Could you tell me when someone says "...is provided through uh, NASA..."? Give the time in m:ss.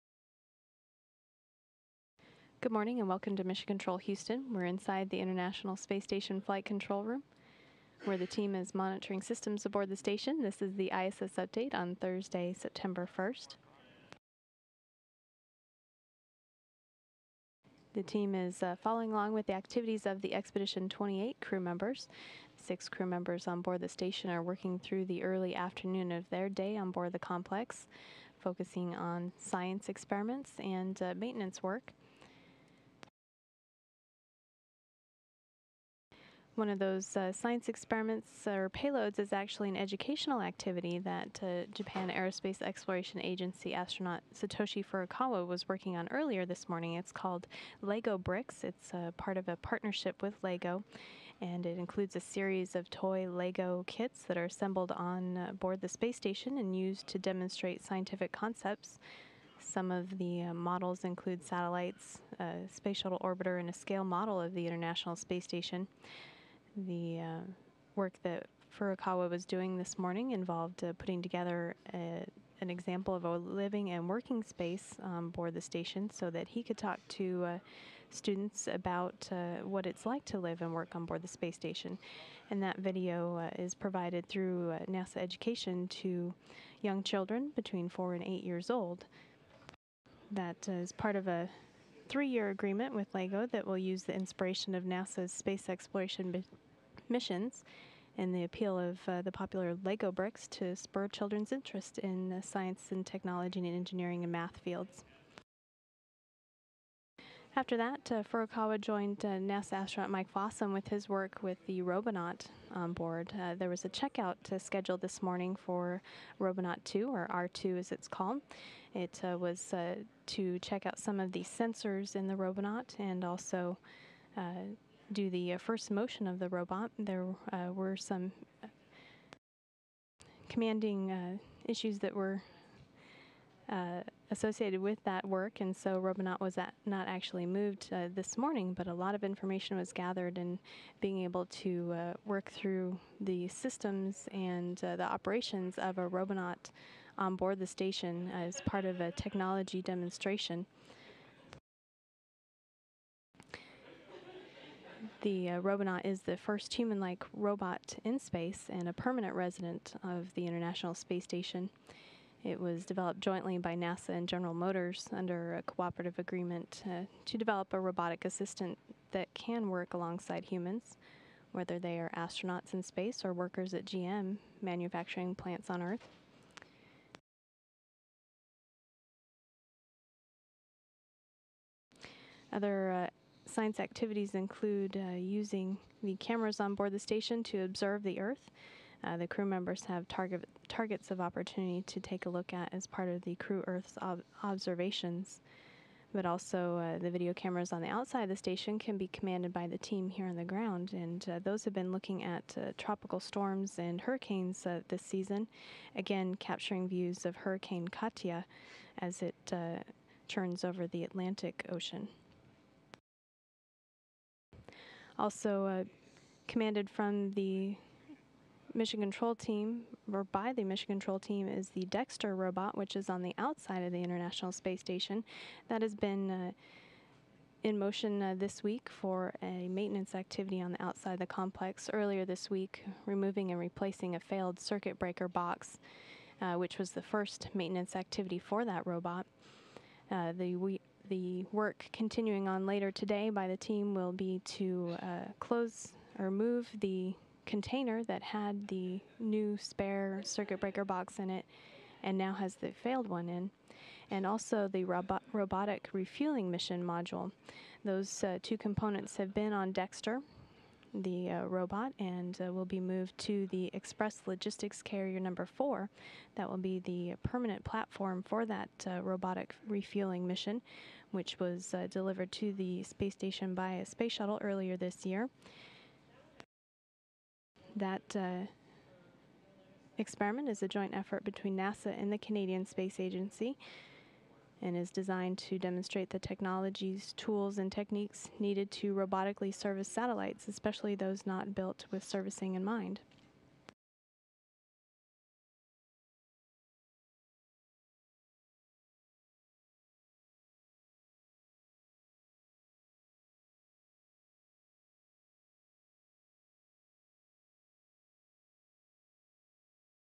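1:23.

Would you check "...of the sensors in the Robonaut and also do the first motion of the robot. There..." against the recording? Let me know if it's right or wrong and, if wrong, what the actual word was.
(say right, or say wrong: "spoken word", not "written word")
right.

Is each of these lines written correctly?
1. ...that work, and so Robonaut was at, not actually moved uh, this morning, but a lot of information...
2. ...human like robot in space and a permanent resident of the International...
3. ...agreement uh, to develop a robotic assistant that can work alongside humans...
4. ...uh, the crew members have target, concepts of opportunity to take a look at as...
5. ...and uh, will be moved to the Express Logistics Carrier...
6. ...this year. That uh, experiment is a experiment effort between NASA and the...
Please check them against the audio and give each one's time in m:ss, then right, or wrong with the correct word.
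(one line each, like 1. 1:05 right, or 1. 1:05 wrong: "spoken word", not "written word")
1. 2:15 right
2. 2:36 right
3. 2:46 right
4. 3:09 wrong: "targets", not "concepts"
5. 4:21 right
6. 4:34 wrong: "joint", not "experiment".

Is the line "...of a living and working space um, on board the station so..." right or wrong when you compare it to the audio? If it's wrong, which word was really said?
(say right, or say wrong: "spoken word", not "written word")
right.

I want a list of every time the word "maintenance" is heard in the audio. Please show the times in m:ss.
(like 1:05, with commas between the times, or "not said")
0:31, 3:49, 3:57.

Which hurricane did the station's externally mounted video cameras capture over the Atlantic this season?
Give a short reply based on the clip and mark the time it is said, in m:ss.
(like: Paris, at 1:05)
Hurricane Katia, at 3:27.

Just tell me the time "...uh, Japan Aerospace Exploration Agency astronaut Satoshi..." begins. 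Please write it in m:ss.
0:41.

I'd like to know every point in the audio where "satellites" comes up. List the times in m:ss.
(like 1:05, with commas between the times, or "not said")
1:01, 4:49.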